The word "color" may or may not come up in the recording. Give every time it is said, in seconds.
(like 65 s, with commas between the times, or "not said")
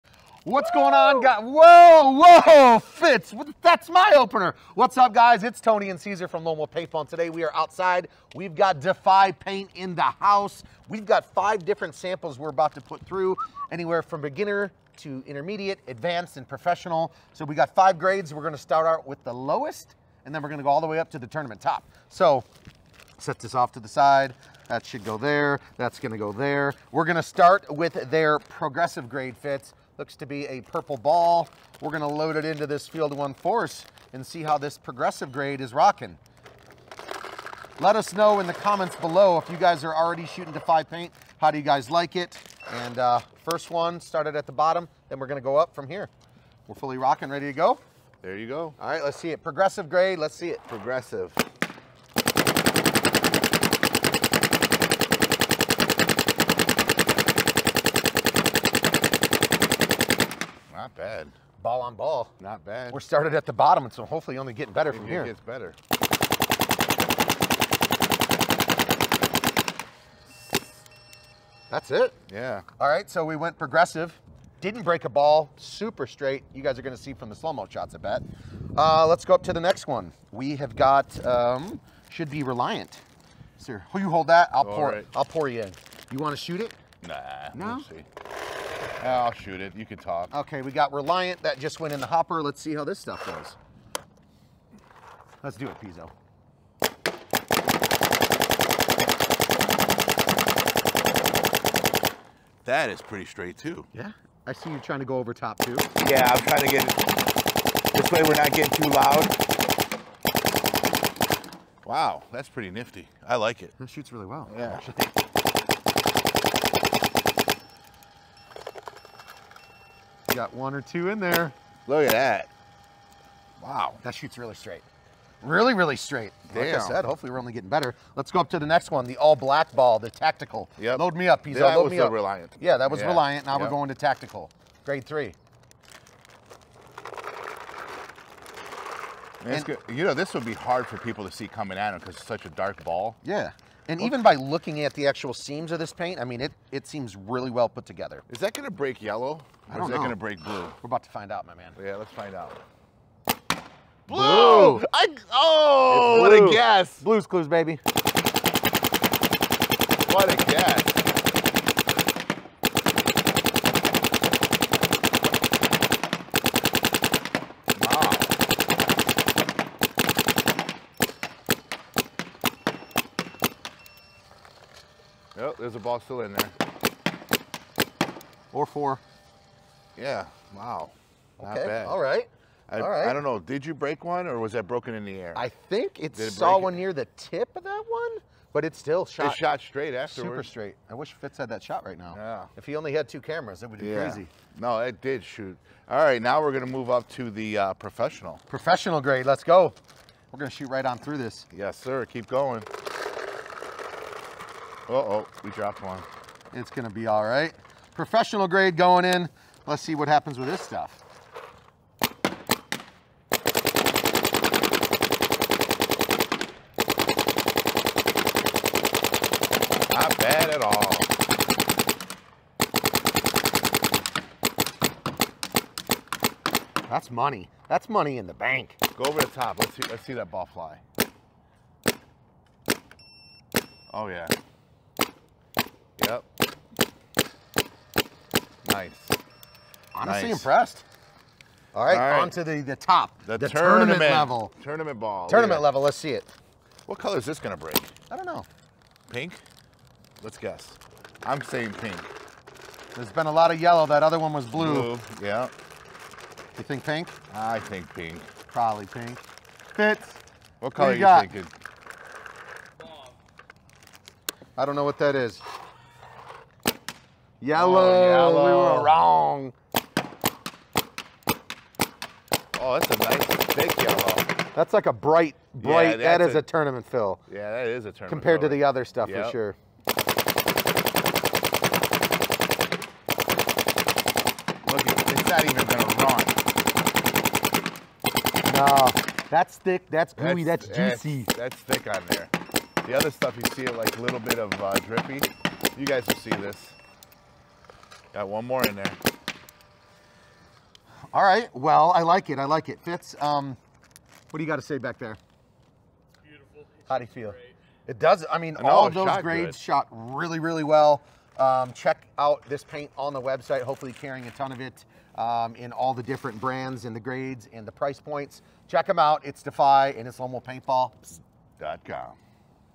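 246 s, 260 s.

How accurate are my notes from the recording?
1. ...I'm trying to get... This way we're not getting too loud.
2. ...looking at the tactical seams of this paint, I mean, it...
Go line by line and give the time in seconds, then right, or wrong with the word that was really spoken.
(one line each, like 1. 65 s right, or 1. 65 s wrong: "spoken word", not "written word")
1. 106 s right
2. 144 s wrong: "actual", not "tactical".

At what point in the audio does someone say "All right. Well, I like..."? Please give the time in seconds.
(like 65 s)
301 s.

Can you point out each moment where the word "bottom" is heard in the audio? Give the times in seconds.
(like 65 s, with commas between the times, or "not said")
44 s, 63 s.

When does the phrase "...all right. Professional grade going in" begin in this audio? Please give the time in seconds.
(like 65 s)
207 s.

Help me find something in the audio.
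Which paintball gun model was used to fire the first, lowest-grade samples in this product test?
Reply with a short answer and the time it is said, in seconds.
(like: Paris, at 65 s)
Field 1 Force, at 32 s.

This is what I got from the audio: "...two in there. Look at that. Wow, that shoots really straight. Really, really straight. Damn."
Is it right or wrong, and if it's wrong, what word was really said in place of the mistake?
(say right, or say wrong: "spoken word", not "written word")
right.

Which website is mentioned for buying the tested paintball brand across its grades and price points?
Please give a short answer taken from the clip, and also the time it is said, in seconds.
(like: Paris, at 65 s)
Paintball.com, at 320 s.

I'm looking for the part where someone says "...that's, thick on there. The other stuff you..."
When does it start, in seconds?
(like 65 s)
291 s.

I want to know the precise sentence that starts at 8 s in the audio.
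We've got Defy Paint in the house.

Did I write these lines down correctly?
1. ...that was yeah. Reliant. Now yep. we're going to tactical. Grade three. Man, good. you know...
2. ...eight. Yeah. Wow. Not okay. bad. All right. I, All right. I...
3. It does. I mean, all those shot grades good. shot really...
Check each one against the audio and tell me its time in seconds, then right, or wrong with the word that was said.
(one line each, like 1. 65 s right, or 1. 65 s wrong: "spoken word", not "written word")
1. 132 s right
2. 178 s wrong: "four", not "eight"
3. 307 s right.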